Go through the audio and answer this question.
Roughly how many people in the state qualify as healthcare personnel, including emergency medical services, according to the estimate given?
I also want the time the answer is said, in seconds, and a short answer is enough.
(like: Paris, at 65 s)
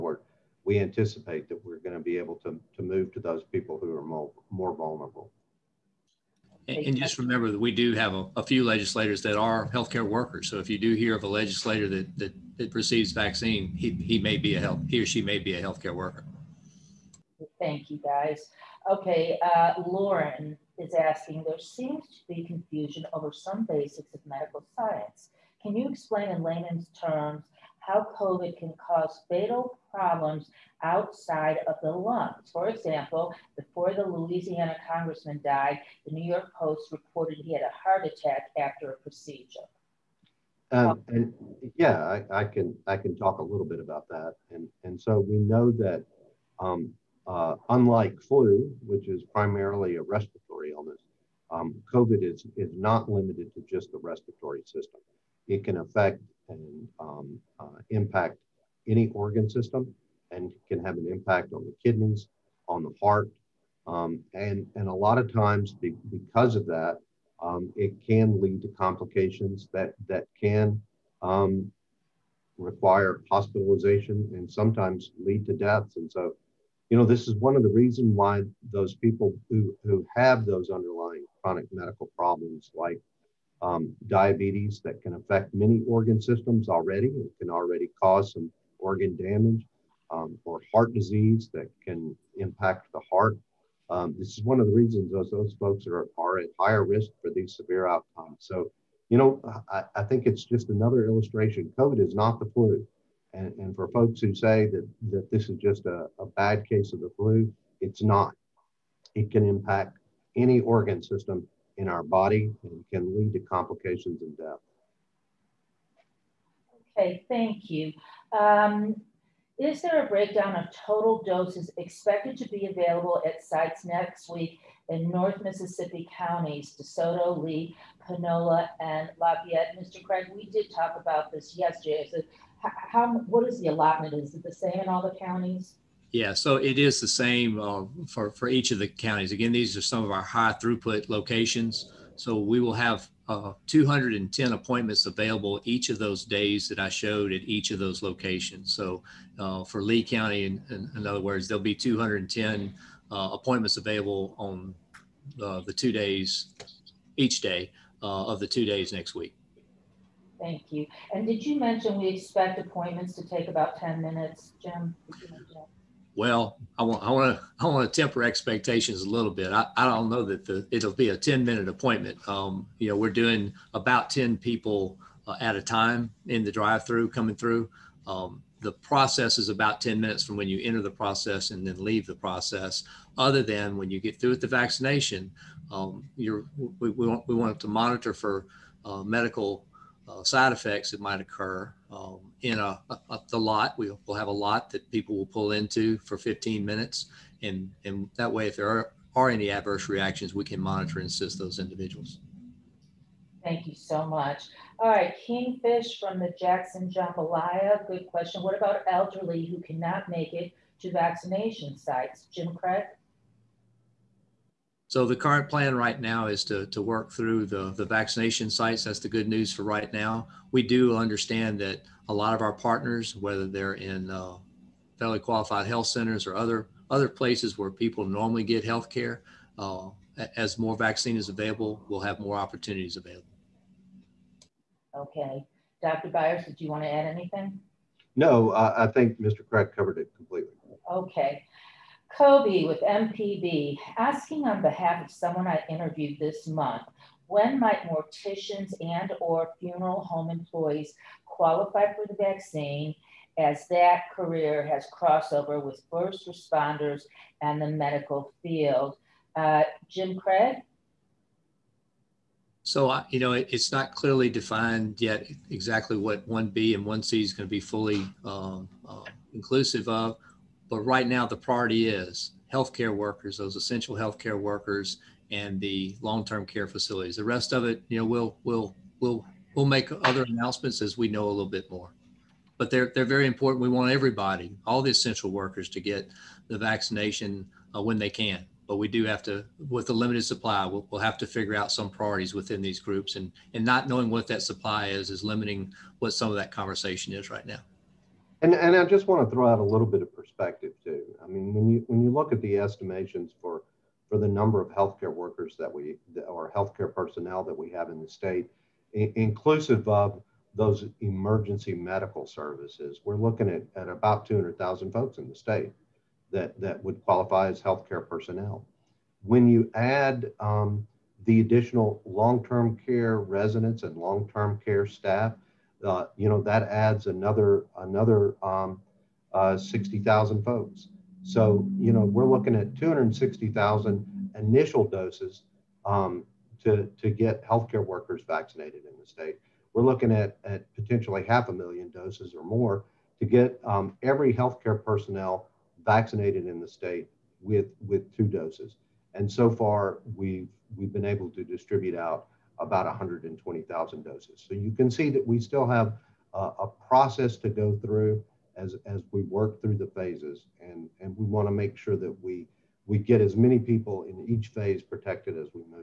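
200,000, at 314 s.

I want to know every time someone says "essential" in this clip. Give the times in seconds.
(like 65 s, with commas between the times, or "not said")
273 s, 284 s.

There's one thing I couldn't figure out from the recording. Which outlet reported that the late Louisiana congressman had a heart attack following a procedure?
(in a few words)
New York Post.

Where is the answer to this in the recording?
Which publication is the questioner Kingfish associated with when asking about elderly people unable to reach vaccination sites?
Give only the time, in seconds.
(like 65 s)
206 s.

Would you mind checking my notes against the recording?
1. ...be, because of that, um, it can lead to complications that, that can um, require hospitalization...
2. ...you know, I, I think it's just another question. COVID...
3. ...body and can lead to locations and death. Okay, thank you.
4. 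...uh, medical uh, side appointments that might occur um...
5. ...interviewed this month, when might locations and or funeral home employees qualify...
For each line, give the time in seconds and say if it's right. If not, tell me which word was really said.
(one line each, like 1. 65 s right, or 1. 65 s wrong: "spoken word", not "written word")
1. 65 s right
2. 99 s wrong: "illustration", not "question"
3. 112 s wrong: "complications", not "locations"
4. 188 s wrong: "effects", not "appointments"
5. 245 s wrong: "morticians", not "locations".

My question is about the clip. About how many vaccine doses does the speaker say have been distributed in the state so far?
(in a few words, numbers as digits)
120,000.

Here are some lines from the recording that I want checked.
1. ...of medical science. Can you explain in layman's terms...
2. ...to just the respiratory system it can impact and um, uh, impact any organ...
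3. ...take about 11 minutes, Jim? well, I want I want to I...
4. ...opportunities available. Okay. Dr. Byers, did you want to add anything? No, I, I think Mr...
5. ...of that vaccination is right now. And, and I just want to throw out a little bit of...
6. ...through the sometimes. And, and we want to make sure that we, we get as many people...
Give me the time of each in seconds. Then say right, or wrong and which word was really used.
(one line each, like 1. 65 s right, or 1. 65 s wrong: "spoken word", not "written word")
1. 24 s right
2. 53 s wrong: "affect", not "impact"
3. 163 s wrong: "10", not "11"
4. 232 s right
5. 296 s wrong: "conversation", not "vaccination"
6. 359 s wrong: "phases", not "sometimes".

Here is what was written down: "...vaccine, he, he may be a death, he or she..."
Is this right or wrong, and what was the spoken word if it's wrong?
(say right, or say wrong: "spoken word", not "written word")
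wrong: "health", not "death".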